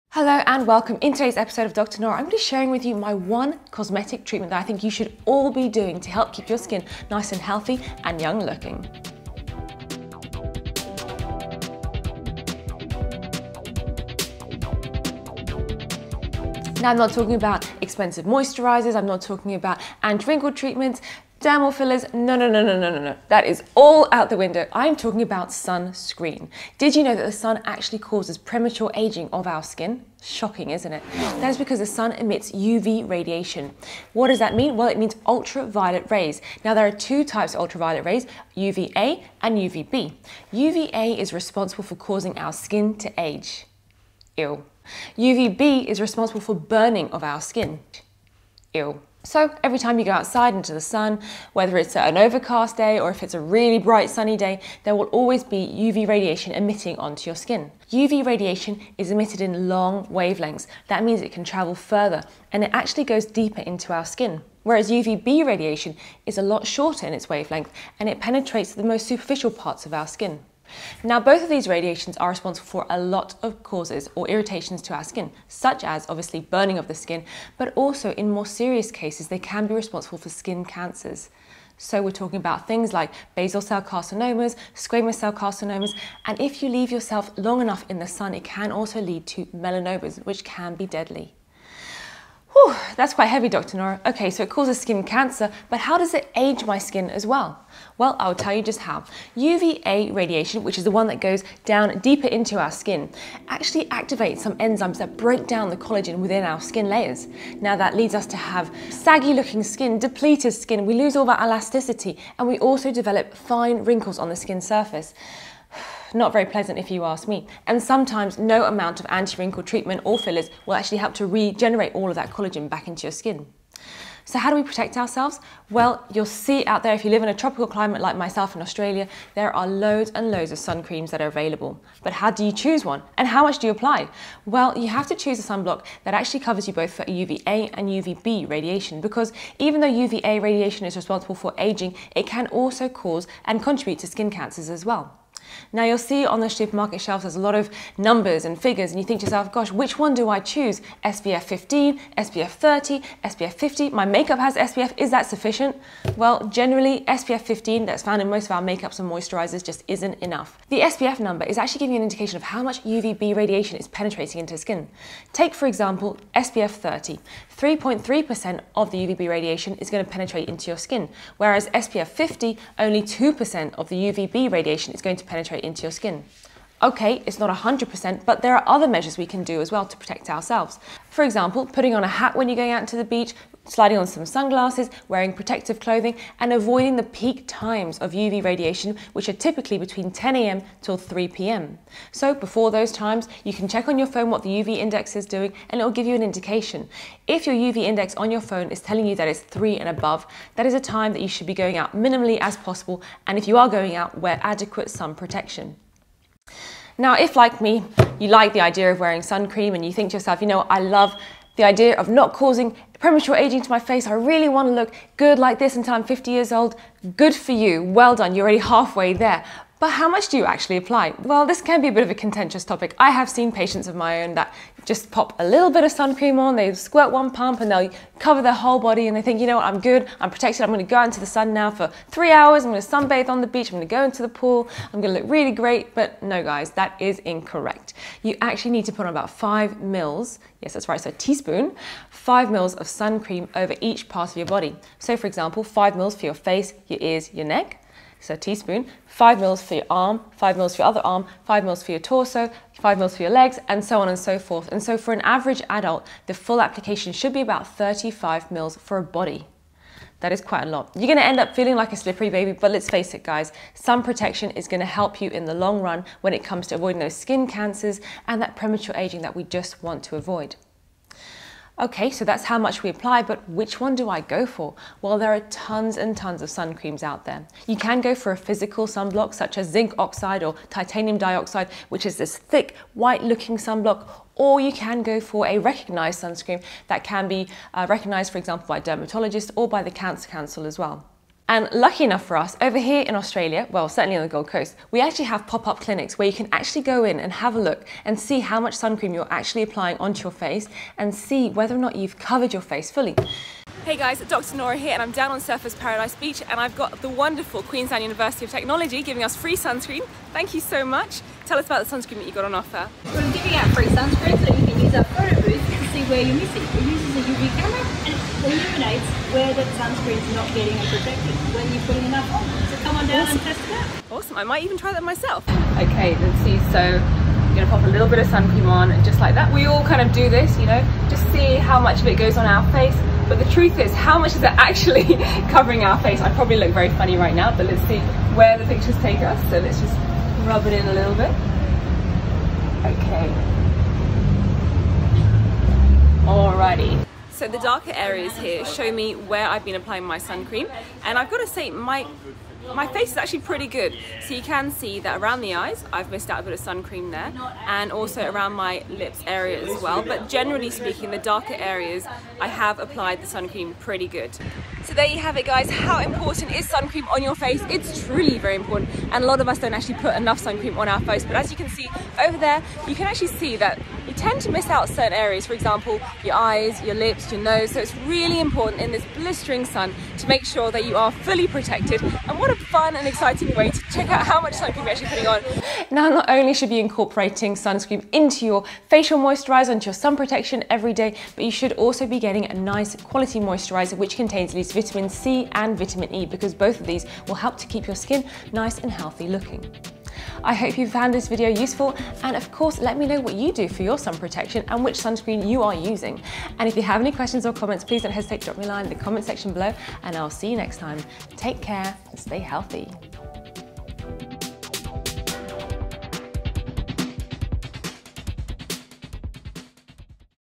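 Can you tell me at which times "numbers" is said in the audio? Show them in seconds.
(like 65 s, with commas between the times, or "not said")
147 s, 161 s.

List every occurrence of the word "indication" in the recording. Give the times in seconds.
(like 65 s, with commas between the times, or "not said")
162 s, 196 s.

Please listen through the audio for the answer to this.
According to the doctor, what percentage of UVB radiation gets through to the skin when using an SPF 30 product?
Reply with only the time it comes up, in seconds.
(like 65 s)
167 s.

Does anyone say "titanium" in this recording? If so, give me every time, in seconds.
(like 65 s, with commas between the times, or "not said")
280 s.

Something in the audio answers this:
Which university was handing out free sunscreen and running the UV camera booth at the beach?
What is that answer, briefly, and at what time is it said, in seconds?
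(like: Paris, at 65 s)
Queensland University of Technology, at 307 s.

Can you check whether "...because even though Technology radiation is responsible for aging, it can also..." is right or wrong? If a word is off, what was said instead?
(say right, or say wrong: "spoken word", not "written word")
wrong: "UVA", not "Technology".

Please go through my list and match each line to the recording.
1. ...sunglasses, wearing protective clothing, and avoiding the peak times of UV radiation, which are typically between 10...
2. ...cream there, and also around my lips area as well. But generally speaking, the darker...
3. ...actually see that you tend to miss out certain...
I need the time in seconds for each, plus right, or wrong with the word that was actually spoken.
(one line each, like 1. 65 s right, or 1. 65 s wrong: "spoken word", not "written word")
1. 184 s right
2. 356 s right
3. 373 s right.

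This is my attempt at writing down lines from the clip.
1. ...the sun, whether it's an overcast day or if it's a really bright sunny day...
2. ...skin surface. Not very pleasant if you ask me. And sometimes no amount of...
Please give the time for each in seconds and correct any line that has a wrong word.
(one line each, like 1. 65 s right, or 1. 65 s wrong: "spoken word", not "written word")
1. 50 s right
2. 114 s right.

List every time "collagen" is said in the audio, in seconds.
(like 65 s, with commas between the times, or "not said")
105 s, 122 s.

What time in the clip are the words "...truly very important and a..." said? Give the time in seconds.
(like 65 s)
368 s.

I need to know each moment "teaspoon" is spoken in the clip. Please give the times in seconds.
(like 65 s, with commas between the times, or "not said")
241 s, 248 s.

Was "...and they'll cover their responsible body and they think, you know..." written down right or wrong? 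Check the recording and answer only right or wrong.
wrong.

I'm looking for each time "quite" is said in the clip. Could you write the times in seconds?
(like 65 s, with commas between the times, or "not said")
93 s, 260 s.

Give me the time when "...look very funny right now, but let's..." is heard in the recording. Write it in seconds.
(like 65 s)
336 s.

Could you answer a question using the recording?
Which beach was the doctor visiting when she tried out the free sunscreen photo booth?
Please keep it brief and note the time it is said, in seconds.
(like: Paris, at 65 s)
Surfers Paradise Beach, at 305 s.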